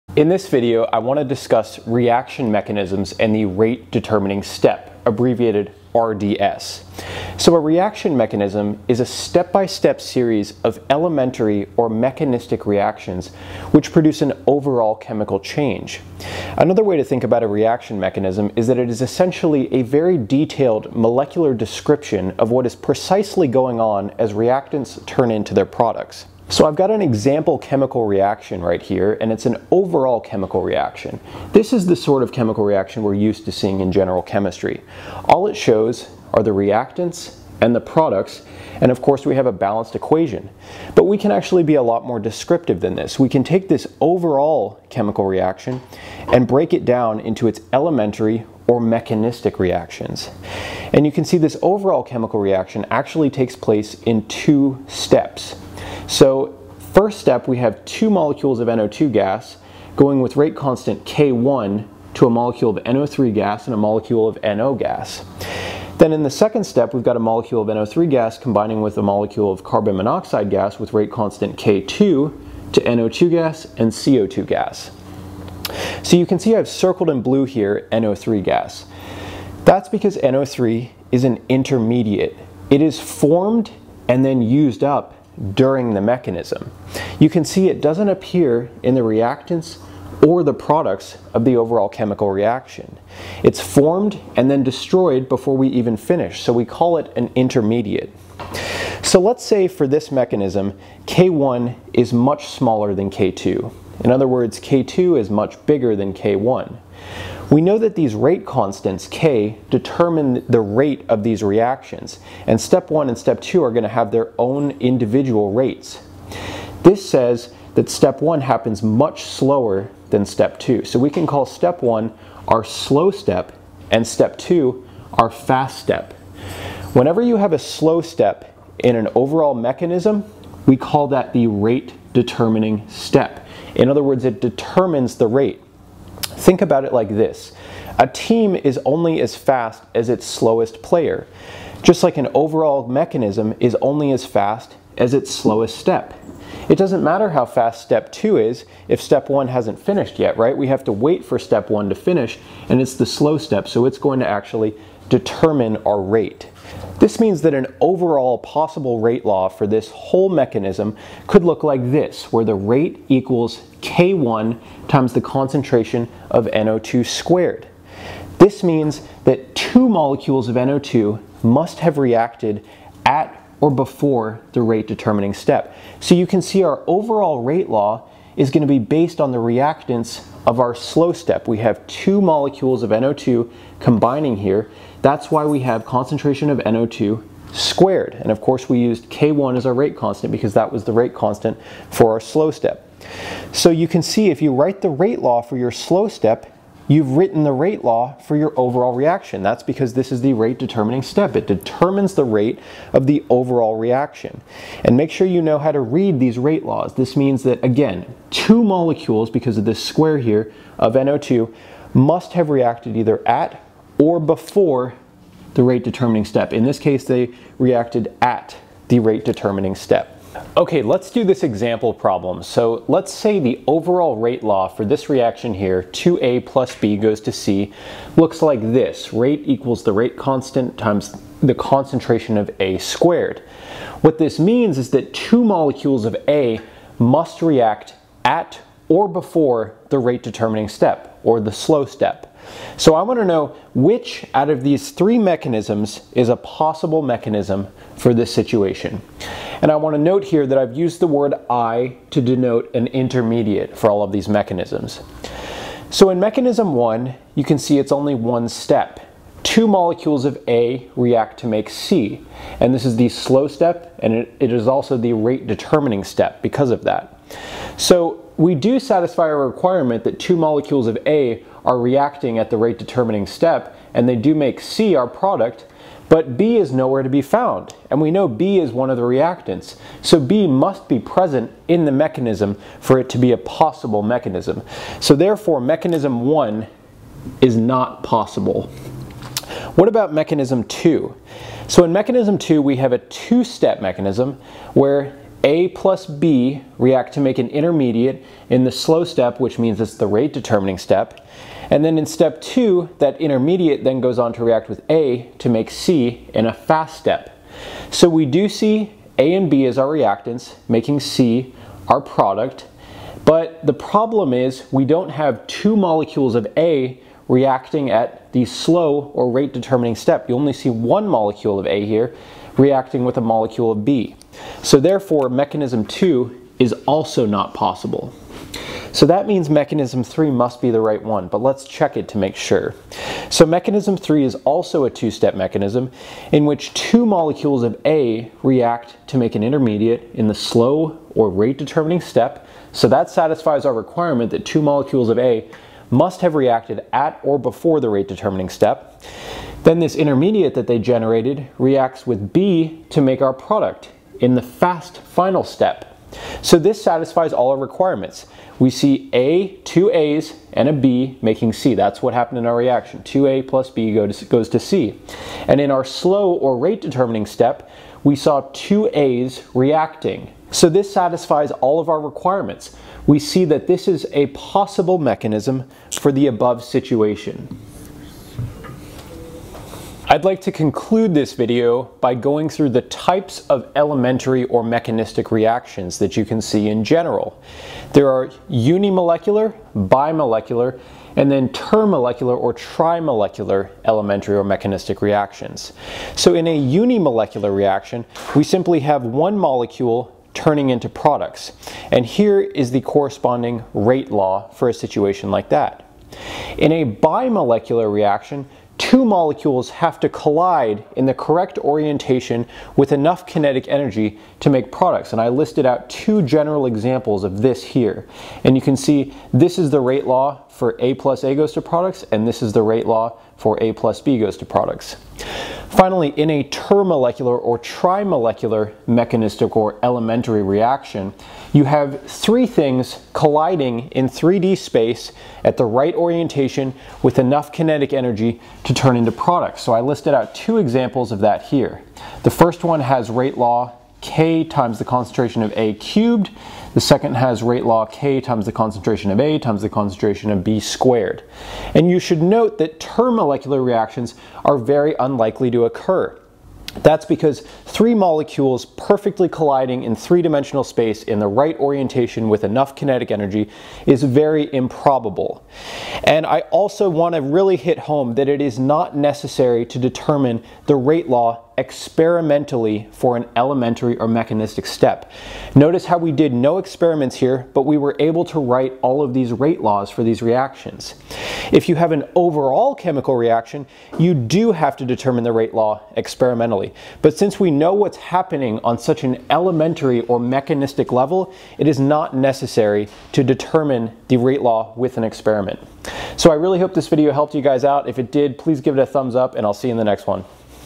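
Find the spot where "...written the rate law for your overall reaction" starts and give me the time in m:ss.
3:17.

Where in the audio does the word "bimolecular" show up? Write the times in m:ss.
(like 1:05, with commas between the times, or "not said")
6:29, 6:46.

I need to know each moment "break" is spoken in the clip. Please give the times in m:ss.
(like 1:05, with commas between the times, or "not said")
0:46.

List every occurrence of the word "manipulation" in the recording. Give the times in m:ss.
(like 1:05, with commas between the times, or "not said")
not said.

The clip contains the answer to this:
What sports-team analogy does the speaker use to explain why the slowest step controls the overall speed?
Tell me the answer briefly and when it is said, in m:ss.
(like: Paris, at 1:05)
slowest player, at 2:17.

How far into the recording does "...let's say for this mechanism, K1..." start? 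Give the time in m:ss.
1:39.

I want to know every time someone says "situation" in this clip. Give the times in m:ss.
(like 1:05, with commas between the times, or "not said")
4:08, 6:16, 6:44.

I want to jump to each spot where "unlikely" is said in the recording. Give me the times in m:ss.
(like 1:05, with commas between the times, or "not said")
7:34.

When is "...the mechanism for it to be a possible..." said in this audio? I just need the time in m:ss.
4:41.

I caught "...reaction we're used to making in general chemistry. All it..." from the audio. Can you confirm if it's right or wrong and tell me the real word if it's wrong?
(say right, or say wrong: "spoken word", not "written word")
wrong: "seeing", not "making".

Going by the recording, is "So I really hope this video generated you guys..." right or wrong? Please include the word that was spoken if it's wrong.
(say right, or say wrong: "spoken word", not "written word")
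wrong: "helped", not "generated".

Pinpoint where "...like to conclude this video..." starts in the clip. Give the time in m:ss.
6:20.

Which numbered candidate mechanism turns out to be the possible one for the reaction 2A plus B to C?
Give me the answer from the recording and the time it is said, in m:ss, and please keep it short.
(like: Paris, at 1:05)
Mechanism 3, at 5:29.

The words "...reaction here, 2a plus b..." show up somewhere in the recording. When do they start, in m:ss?
3:45.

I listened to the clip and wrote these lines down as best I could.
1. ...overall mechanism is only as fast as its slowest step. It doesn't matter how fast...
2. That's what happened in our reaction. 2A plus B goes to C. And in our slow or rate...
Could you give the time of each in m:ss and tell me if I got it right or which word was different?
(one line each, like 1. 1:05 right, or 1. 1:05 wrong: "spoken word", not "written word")
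1. 2:22 right
2. 6:01 right.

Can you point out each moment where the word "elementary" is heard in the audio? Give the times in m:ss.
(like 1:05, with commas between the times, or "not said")
0:10, 0:47, 6:23, 6:33, 7:09, 7:53, 8:09.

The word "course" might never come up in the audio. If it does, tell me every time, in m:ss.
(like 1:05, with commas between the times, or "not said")
0:39, 3:08.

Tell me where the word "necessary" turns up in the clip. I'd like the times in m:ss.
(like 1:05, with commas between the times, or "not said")
7:48, 8:12.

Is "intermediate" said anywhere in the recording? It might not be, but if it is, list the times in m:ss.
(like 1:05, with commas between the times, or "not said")
1:21, 1:37, 4:12, 4:57, 5:03, 5:39, 5:49.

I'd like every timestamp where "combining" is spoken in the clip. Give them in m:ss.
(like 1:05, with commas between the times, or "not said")
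1:08, 3:03.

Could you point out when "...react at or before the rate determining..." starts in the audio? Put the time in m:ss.
3:57.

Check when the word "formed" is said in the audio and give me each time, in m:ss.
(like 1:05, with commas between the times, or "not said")
1:22, 1:33.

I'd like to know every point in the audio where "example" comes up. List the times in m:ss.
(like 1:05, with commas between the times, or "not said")
0:27, 3:41, 6:56, 7:20.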